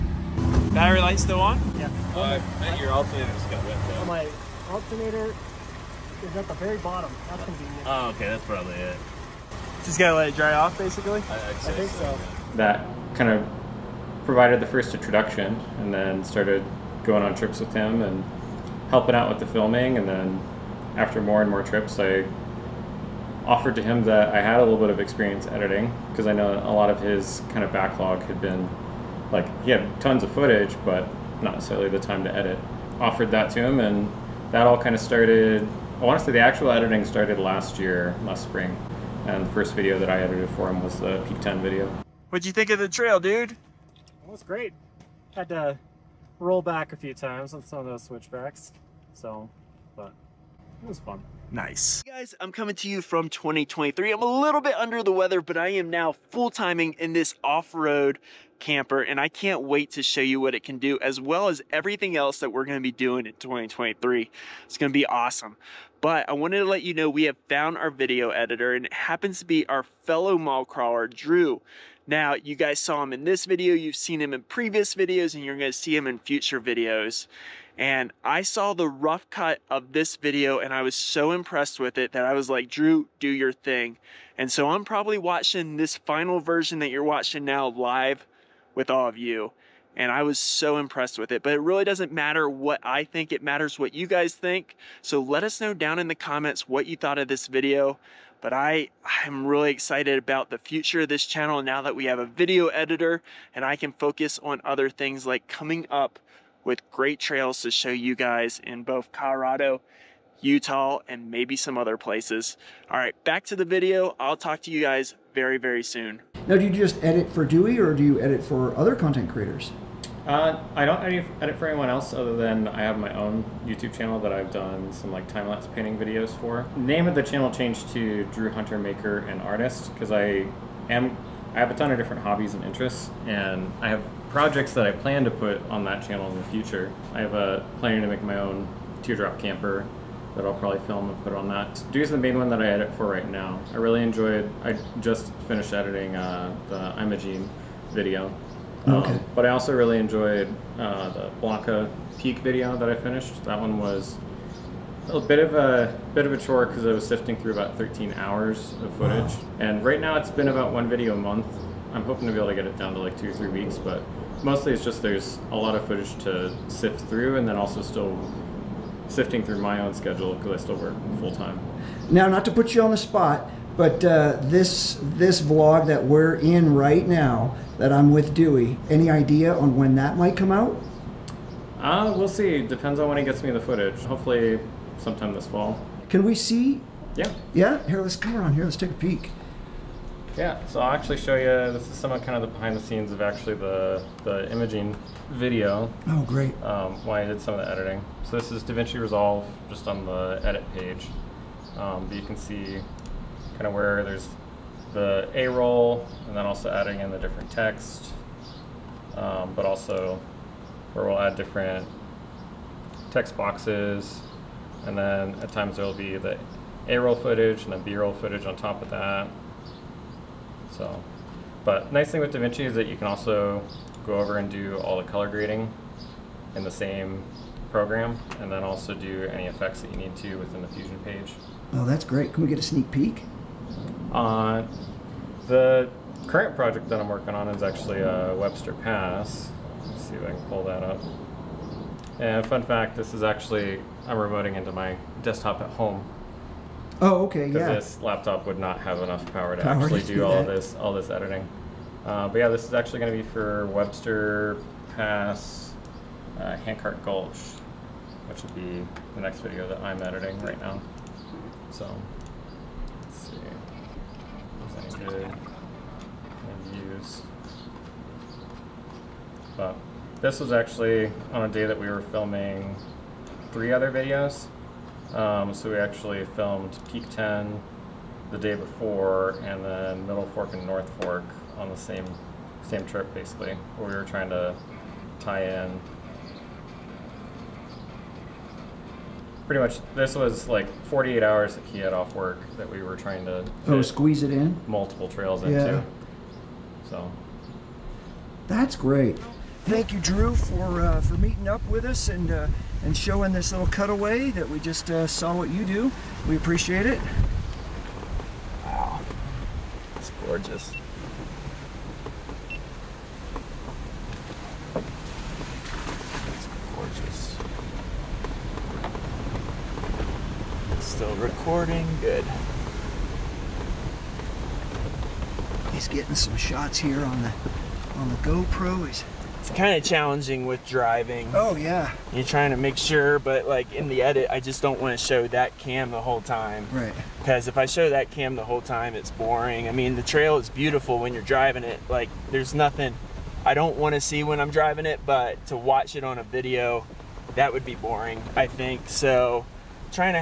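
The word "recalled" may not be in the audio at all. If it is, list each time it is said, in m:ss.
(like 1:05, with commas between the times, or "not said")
not said.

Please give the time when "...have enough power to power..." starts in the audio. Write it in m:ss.
4:08.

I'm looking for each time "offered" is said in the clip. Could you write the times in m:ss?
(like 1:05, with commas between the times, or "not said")
0:23, 0:32.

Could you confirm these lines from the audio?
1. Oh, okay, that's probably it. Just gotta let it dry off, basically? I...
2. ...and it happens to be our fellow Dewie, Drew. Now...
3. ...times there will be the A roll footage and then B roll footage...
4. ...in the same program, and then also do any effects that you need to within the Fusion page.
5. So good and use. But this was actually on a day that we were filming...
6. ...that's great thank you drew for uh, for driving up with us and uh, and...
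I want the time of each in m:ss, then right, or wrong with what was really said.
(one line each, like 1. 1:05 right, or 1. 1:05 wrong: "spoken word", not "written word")
1. 0:07 right
2. 1:08 wrong: "Mallcrawler", not "Dewie"
3. 3:35 right
4. 3:46 right
5. 4:21 right
6. 4:58 wrong: "meeting", not "driving".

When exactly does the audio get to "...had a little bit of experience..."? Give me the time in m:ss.
0:24.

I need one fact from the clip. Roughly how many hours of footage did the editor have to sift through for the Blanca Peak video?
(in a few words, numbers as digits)
13.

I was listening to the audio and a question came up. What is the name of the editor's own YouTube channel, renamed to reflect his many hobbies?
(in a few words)
Drew Hunter Maker and Artist.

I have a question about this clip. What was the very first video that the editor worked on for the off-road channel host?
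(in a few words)
Peak 10.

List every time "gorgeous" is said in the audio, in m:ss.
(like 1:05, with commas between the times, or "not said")
5:10.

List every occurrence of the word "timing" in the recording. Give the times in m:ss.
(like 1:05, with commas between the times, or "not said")
0:56.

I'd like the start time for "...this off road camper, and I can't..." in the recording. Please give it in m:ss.
0:57.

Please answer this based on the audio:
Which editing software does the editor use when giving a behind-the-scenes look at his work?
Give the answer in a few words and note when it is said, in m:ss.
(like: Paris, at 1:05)
DaVinci Resolve, at 3:18.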